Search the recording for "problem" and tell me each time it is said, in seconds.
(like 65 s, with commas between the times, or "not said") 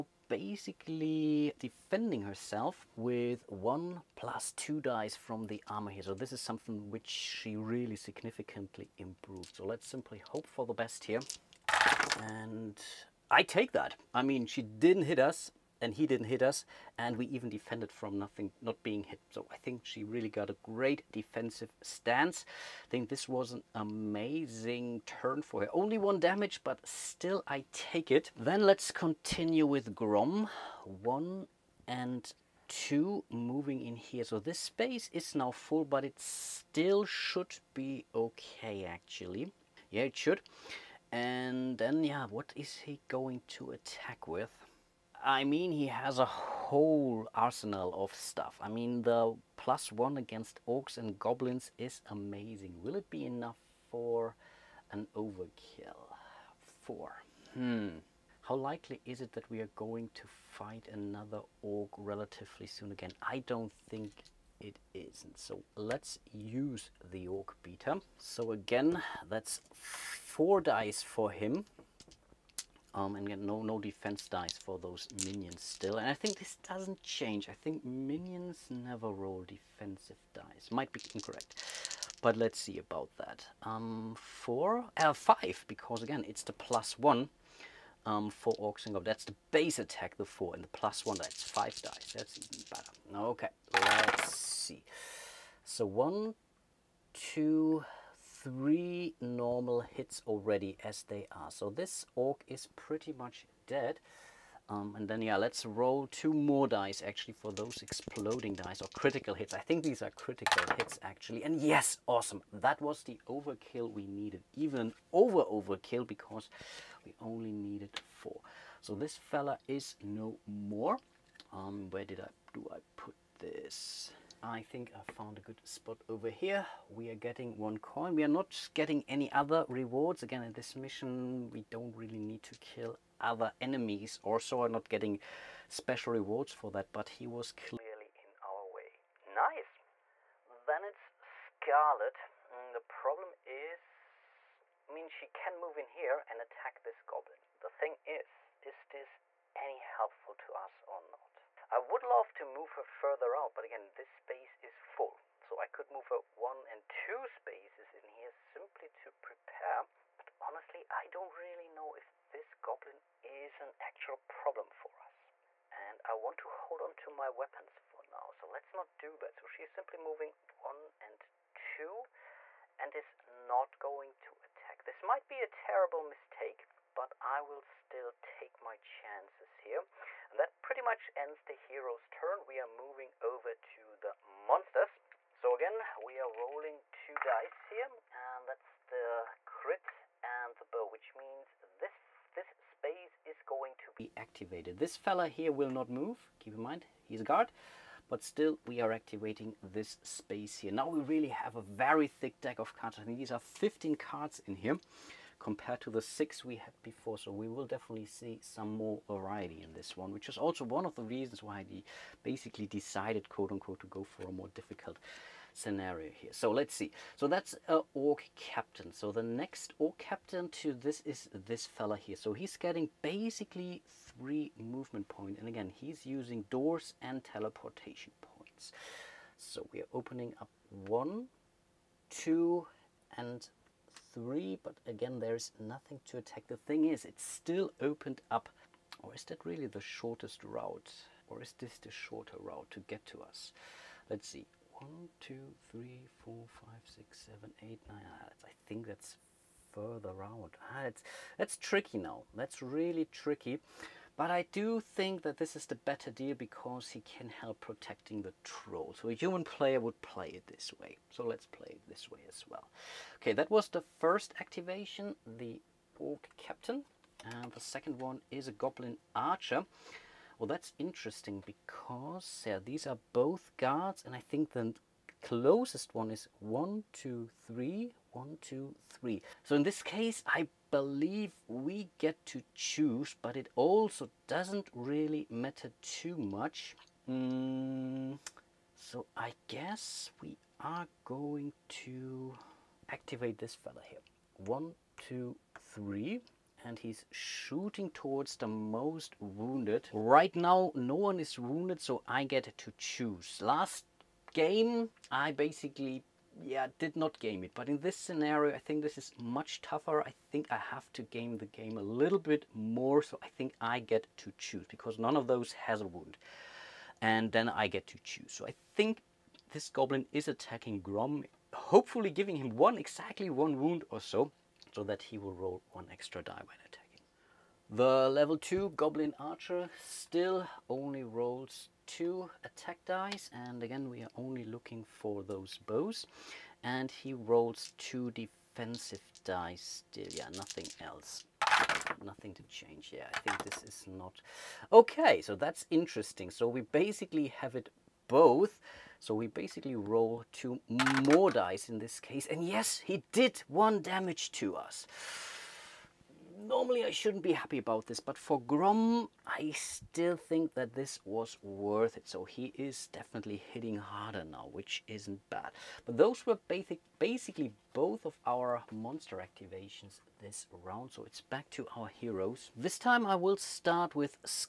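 142 s, 164 s.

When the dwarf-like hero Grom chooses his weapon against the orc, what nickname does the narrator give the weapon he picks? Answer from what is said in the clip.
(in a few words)
orc beater.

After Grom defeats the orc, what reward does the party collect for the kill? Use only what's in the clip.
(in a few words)
1 coin.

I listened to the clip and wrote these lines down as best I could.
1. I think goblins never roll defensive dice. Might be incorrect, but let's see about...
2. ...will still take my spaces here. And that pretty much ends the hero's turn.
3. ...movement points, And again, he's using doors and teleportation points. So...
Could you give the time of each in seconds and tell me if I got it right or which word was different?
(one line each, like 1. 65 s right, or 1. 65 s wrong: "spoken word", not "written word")
1. 77 s wrong: "minions", not "goblins"
2. 177 s wrong: "chances", not "spaces"
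3. 224 s right.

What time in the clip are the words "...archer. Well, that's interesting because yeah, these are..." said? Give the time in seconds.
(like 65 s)
269 s.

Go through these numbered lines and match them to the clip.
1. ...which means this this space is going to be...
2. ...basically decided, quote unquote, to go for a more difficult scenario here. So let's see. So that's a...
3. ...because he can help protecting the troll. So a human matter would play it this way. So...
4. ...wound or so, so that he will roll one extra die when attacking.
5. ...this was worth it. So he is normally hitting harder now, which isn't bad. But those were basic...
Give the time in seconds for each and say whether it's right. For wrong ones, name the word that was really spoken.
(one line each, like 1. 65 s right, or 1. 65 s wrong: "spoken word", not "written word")
1. 190 s right
2. 212 s right
3. 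256 s wrong: "player", not "matter"
4. 323 s right
5. 360 s wrong: "definitely", not "normally".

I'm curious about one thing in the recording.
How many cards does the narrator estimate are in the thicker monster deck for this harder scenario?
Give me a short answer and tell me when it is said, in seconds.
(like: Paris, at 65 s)
15, at 203 s.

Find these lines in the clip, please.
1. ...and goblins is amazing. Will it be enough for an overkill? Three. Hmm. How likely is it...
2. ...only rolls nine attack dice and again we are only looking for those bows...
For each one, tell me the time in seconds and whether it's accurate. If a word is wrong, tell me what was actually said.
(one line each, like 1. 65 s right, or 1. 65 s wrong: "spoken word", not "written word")
1. 50 s wrong: "Four", not "Three"
2. 330 s wrong: "two", not "nine".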